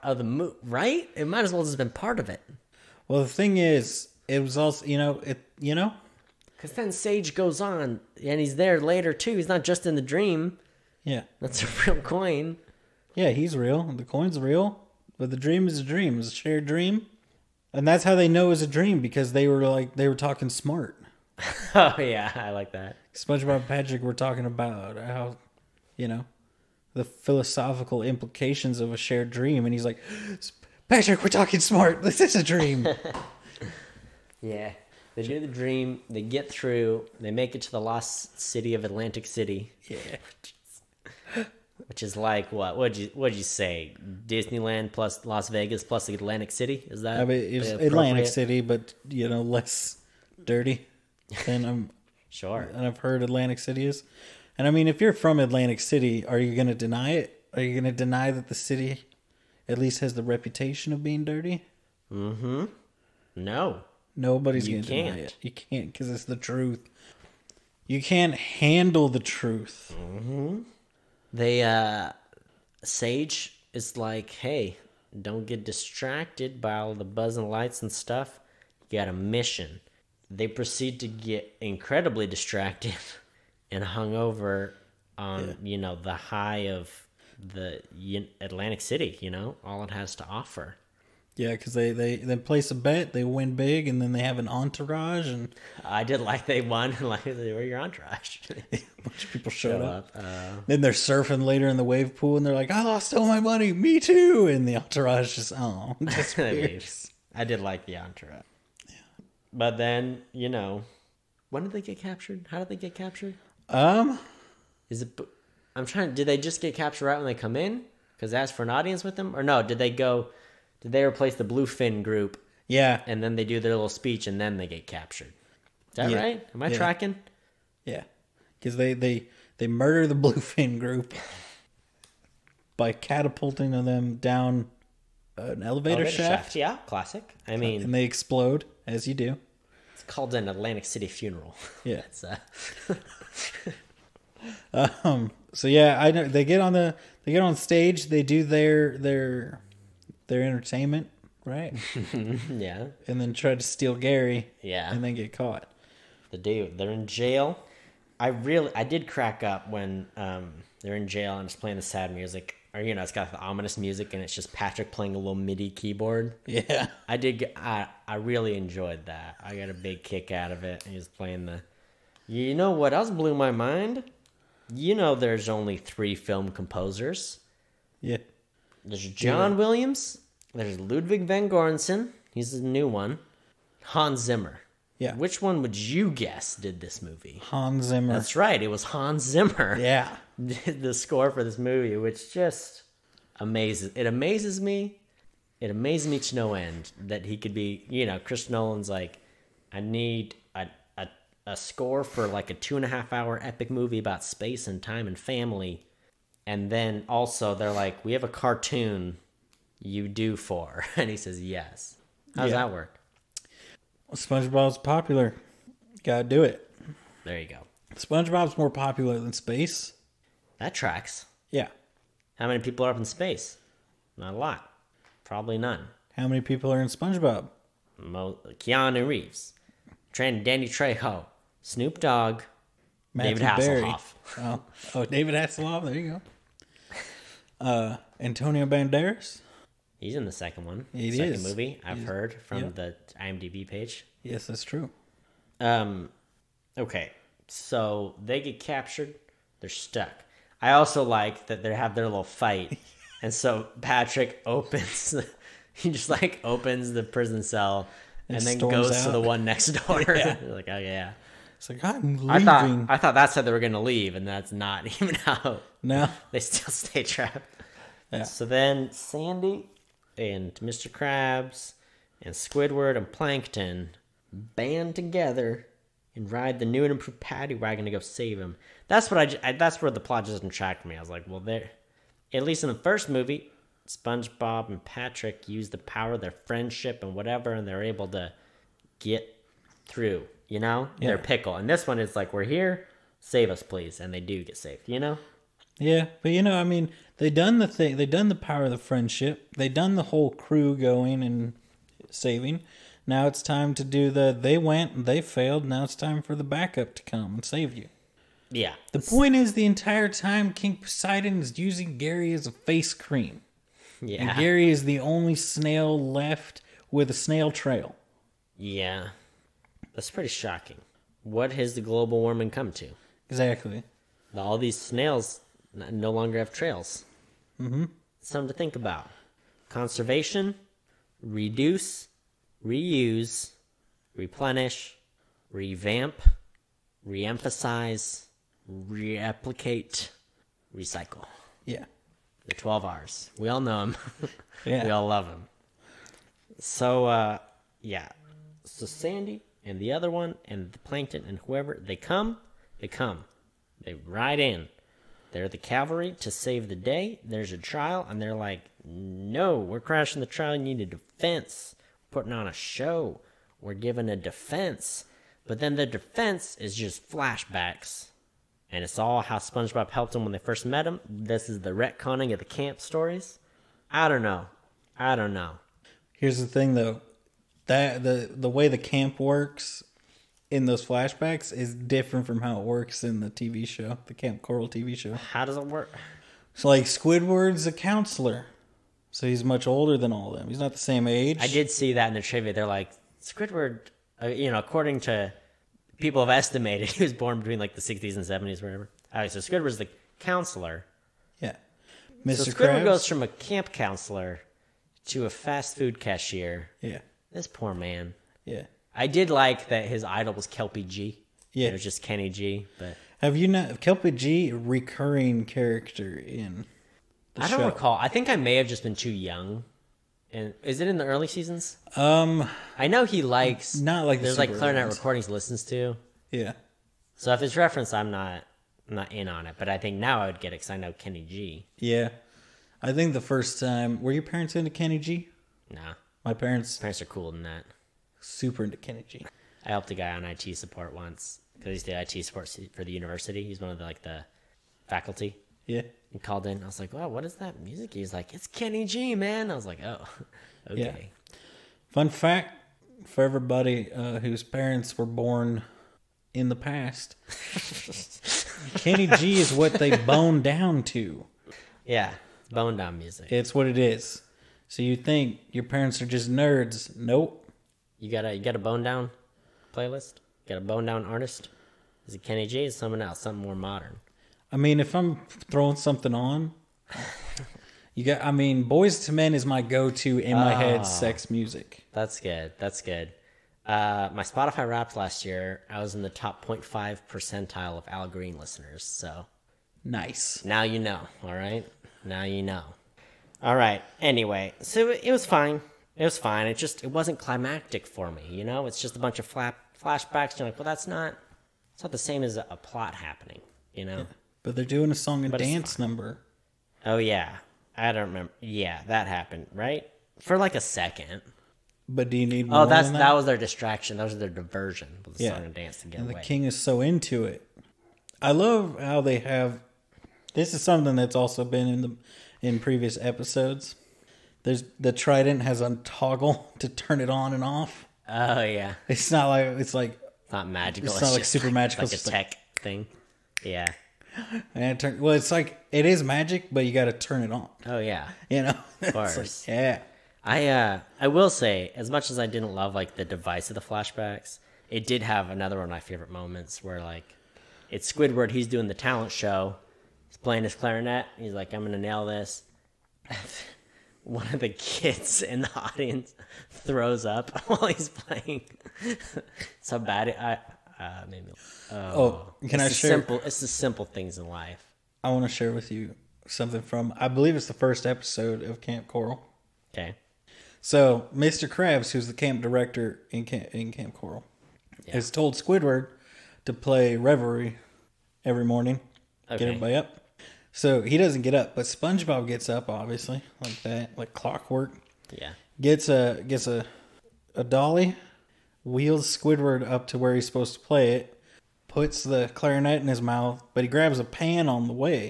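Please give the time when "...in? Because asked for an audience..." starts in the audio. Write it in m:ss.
1:57.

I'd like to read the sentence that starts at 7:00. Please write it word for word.
And is it in the early seasons?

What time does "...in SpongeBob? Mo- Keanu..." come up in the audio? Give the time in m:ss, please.
3:46.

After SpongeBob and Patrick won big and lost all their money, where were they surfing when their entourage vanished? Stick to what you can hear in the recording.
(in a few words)
wave pool.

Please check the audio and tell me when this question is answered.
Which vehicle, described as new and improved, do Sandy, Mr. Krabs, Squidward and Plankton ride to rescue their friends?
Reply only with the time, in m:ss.
4:37.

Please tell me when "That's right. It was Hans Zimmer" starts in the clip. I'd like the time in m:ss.
3:08.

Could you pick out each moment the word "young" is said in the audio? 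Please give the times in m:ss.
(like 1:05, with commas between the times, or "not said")
6:59.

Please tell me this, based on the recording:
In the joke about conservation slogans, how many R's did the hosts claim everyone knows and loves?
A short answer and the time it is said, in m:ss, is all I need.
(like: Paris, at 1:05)
12, at 5:42.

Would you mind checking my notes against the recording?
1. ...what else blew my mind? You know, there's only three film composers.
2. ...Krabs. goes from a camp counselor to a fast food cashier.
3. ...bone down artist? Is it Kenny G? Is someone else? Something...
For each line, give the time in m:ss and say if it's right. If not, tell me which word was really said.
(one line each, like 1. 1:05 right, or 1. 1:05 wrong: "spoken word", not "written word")
1. 2:52 right
2. 6:42 right
3. 7:50 right.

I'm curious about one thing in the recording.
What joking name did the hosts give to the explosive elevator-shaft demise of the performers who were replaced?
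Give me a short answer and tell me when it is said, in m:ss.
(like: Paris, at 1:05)
Atlantic City funeral, at 2:20.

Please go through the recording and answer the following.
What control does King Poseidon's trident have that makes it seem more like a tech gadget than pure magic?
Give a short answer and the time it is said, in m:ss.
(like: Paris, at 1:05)
a toggle, at 8:45.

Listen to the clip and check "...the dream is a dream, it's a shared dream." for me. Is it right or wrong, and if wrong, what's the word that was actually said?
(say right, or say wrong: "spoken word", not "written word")
right.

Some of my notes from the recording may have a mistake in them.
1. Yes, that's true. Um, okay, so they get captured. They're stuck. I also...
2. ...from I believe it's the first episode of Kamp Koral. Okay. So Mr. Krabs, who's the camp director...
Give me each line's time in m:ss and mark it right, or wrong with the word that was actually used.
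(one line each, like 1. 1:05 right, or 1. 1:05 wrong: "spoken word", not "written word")
1. 4:04 right
2. 9:26 right.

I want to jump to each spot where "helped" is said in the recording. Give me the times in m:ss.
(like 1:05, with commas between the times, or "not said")
6:09, 7:19.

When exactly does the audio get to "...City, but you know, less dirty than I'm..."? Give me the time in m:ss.
0:48.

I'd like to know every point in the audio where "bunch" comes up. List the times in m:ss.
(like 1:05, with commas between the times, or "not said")
1:39, 8:18.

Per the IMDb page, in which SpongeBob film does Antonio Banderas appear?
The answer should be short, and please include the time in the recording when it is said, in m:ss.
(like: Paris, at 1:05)
the second one, at 4:00.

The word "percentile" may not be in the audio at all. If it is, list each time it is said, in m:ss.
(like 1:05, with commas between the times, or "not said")
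8:07.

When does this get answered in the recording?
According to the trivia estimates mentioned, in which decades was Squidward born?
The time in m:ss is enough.
6:37.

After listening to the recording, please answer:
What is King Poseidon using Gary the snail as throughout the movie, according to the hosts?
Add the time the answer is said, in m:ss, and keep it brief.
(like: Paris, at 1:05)
face cream, at 5:12.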